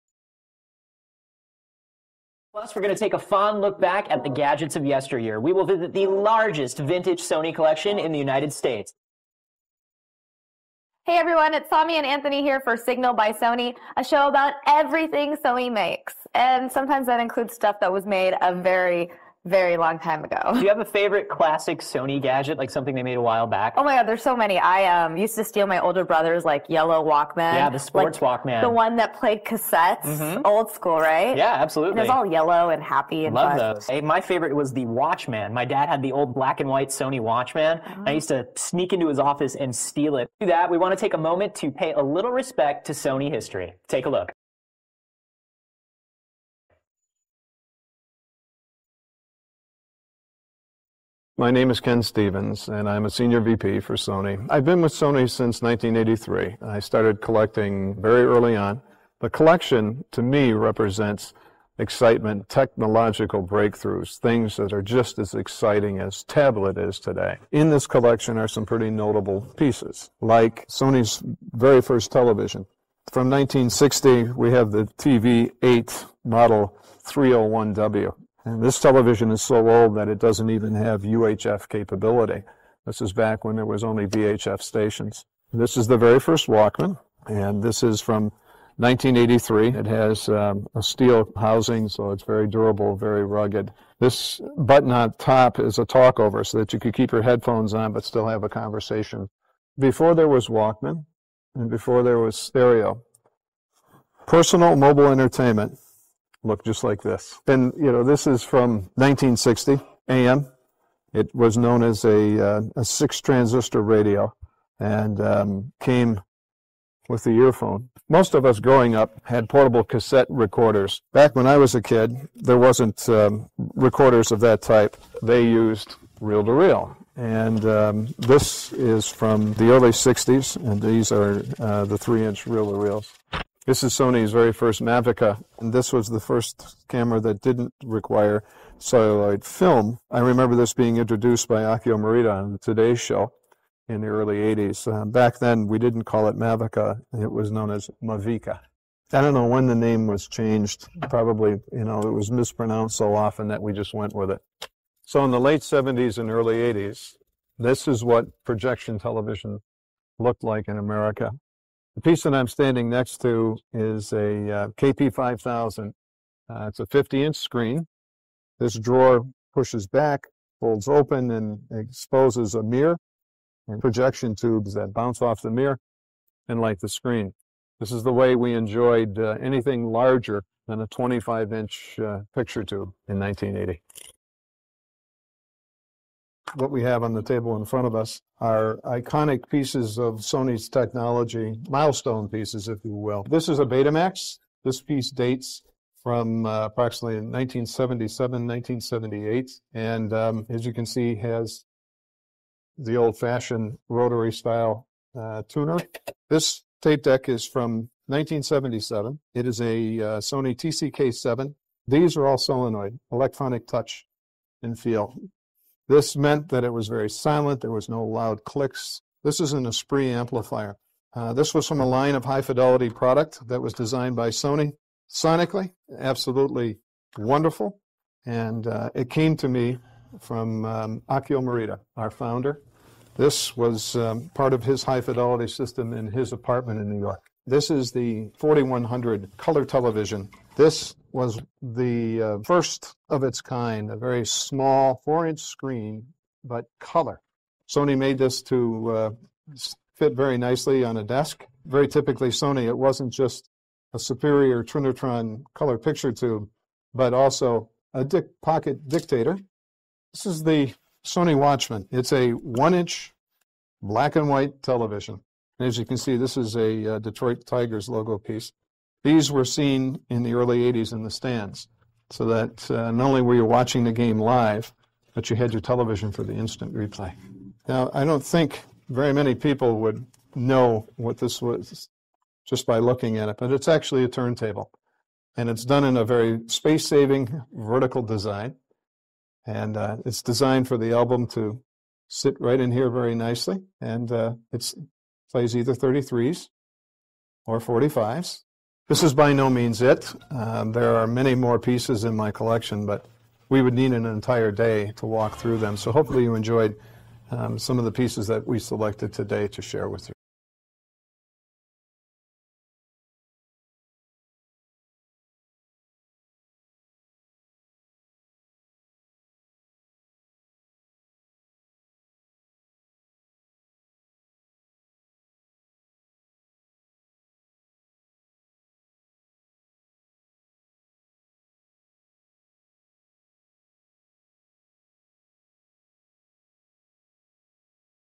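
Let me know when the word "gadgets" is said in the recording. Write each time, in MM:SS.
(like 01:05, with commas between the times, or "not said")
00:04, 00:22.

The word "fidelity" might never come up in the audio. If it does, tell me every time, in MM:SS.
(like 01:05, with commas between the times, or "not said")
03:42, 03:55.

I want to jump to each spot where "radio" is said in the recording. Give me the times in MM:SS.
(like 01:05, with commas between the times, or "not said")
01:53.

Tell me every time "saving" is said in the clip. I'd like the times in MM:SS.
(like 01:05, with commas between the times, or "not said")
04:46.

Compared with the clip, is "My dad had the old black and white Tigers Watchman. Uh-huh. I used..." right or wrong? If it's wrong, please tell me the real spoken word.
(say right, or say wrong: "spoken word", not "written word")
wrong: "Sony", not "Tigers".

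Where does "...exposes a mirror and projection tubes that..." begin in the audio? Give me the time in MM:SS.
02:51.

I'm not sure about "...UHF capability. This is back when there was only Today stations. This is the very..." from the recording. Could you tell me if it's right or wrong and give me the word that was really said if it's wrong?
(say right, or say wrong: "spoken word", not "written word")
wrong: "VHF", not "Today".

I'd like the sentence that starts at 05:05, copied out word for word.
So hopefully you enjoyed um, some of the pieces that we selected today to share with you.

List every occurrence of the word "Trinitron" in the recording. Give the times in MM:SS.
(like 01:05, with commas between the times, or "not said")
04:14.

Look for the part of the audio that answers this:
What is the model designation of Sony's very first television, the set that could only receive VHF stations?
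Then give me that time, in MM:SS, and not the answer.
01:14.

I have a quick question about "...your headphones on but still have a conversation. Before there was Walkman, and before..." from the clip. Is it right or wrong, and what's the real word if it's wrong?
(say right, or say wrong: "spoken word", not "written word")
right.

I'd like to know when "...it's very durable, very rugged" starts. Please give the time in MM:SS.
01:32.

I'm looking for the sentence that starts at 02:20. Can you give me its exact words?
I remember this being introduced by Akio Morita on the Today Show in the early 80s.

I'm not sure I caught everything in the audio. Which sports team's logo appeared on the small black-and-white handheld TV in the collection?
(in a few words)
Detroit Tigers.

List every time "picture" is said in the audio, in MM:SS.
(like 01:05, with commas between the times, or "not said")
03:02, 04:15.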